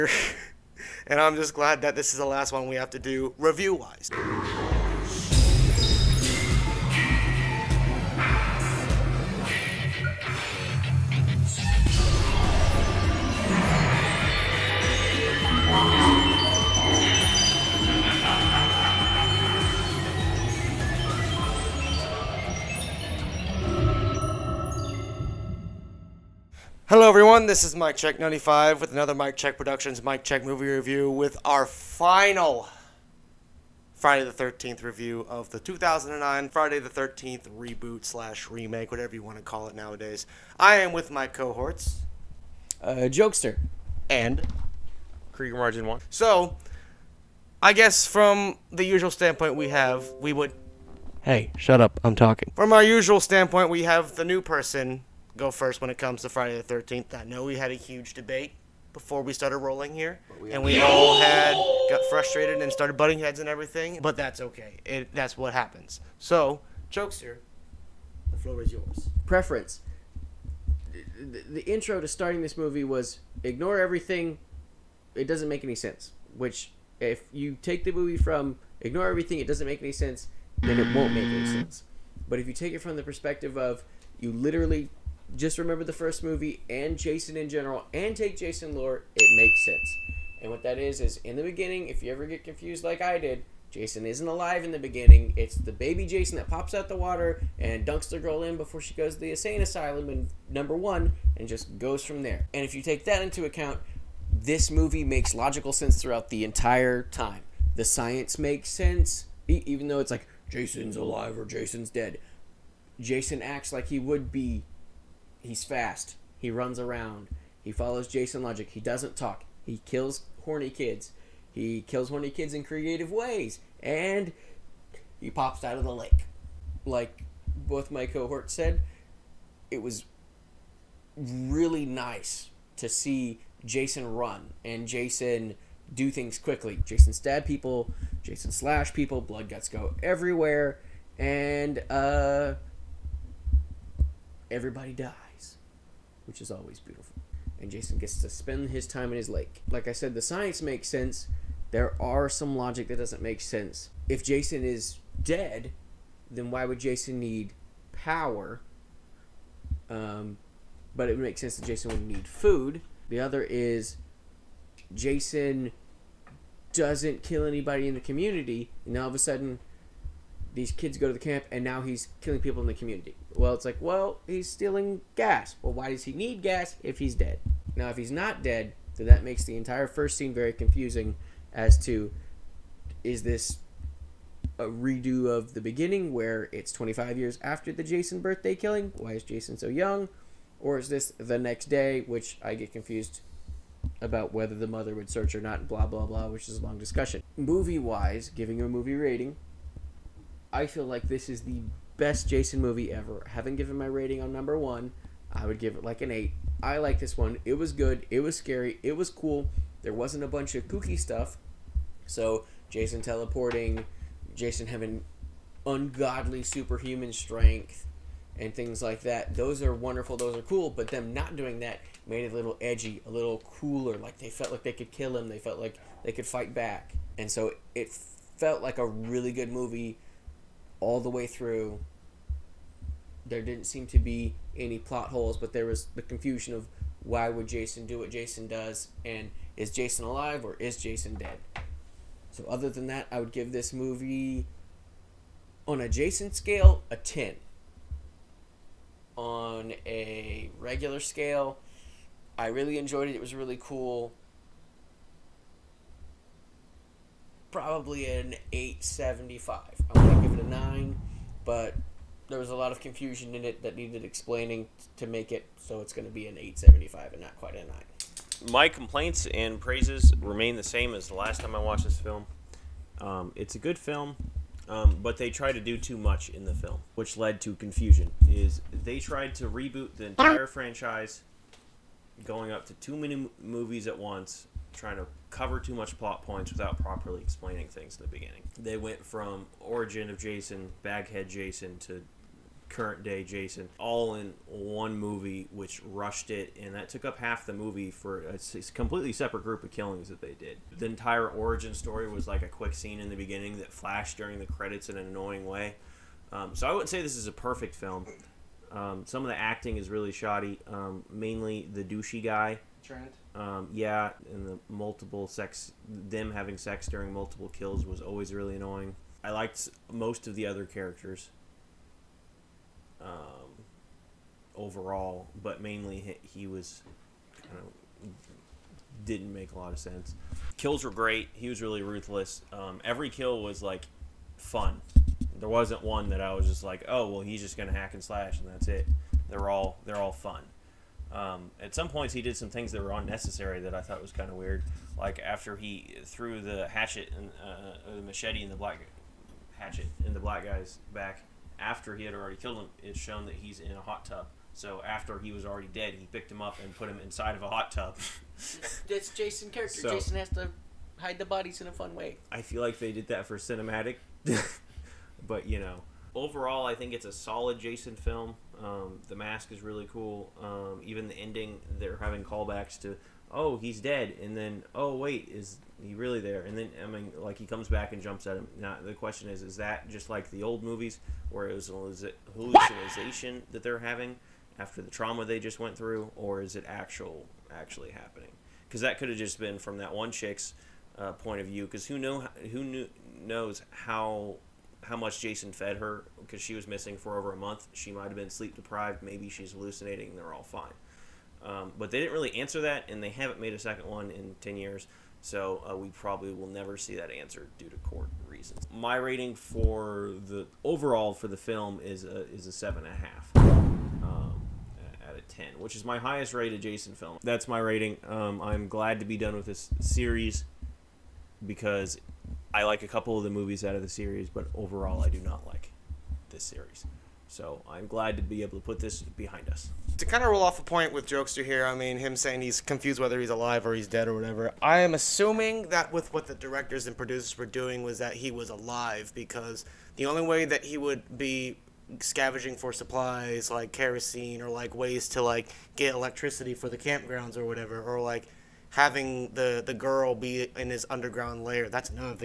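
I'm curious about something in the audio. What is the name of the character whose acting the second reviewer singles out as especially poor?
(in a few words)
Trent.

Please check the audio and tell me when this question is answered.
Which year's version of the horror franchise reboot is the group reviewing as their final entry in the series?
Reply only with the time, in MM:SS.
00:35.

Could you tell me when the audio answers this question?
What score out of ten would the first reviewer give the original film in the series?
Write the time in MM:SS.
03:26.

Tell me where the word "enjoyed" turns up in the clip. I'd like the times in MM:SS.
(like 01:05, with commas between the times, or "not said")
04:12.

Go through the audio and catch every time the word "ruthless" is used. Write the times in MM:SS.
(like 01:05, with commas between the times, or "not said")
05:31.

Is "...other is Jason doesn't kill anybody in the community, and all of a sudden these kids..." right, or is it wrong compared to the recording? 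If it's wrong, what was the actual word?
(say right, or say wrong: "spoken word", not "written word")
right.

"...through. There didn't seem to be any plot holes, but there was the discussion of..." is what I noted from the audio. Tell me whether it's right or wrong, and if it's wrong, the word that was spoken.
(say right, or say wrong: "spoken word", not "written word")
wrong: "confusion", not "discussion".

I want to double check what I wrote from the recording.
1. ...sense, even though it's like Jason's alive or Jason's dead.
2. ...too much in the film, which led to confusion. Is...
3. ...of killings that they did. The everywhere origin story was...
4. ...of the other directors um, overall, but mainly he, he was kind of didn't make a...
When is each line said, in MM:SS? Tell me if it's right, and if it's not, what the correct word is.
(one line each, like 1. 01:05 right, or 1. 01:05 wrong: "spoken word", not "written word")
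1. 01:48 right
2. 04:35 right
3. 04:59 wrong: "entire", not "everywhere"
4. 05:20 wrong: "characters", not "directors".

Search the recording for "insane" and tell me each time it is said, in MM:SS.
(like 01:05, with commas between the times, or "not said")
01:39.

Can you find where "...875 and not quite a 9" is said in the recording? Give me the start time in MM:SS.
04:26.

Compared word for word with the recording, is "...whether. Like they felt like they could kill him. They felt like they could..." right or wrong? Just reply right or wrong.
wrong.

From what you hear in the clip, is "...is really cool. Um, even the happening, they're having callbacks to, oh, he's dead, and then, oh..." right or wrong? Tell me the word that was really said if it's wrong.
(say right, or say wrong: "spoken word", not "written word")
wrong: "ending", not "happening".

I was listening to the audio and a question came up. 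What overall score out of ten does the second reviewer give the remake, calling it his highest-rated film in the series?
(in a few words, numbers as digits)
7.5.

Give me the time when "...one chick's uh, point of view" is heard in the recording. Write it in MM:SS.
06:29.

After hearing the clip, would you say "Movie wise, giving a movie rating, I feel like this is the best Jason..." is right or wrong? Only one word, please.
right.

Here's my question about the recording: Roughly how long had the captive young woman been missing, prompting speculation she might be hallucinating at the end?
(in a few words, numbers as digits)
Over a month.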